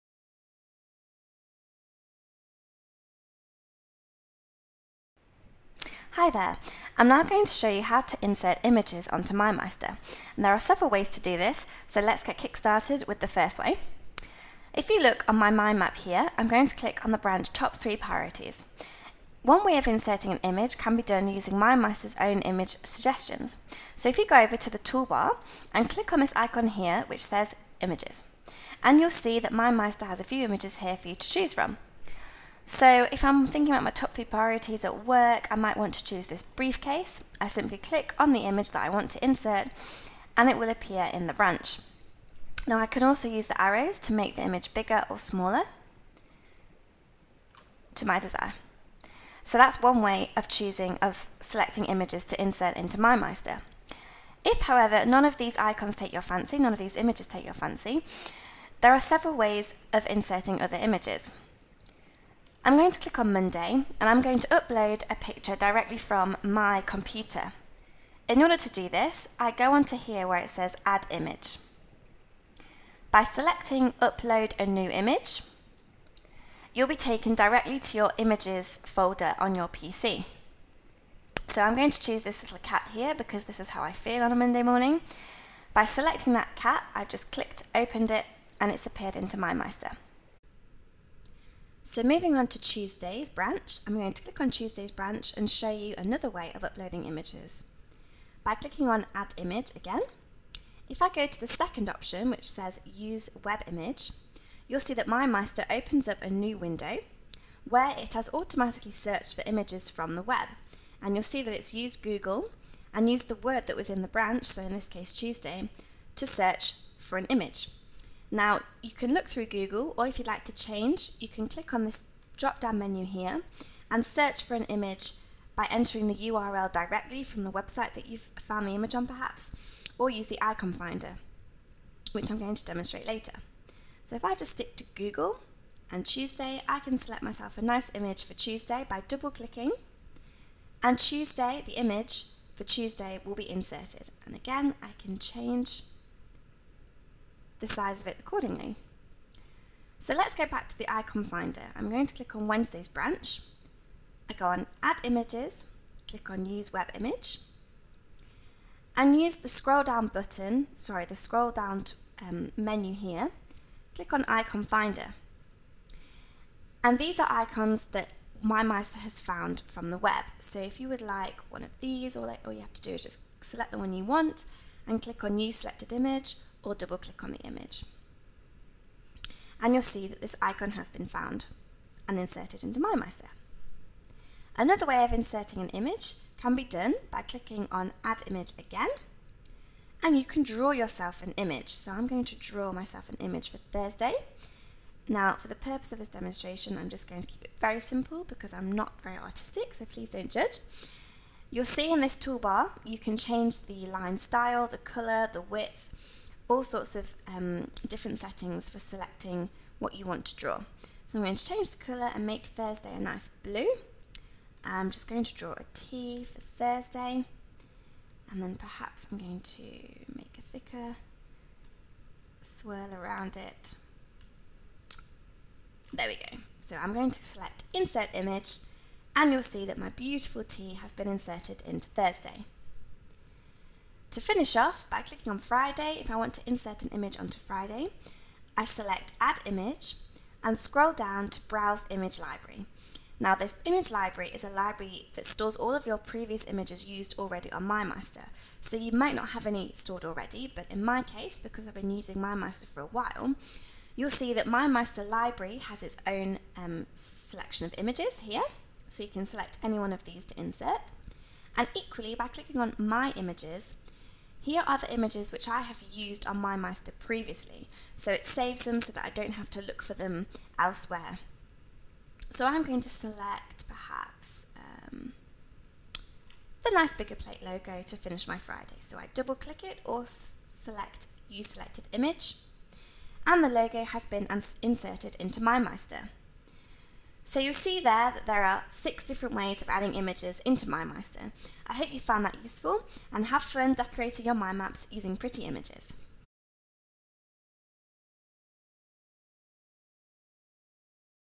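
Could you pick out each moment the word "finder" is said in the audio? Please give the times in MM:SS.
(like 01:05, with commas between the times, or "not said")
02:10, 02:31, 02:44.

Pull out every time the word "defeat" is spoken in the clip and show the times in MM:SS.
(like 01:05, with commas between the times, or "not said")
not said.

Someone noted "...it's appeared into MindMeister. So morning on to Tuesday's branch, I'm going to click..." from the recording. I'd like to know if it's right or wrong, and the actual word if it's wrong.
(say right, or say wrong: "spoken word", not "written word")
wrong: "moving", not "morning".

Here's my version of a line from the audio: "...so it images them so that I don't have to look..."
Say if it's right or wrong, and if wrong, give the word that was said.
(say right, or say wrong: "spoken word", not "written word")
wrong: "saves", not "images".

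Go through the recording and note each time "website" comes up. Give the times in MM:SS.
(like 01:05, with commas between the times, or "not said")
02:07.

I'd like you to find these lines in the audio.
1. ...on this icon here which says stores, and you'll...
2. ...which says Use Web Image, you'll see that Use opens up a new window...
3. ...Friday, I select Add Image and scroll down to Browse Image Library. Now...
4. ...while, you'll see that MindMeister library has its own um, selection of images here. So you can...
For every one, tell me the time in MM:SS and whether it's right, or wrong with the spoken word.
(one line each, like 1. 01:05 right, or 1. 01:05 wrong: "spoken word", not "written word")
1. 00:26 wrong: "images", not "stores"
2. 01:42 wrong: "MindMeister", not "Use"
3. 03:57 right
4. 04:12 right.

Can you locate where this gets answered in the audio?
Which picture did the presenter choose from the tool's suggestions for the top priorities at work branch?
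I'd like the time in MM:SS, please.
00:36.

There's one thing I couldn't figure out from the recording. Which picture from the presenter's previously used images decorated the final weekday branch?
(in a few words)
Biggerplate.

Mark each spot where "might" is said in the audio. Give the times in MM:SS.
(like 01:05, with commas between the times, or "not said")
00:35, 04:08.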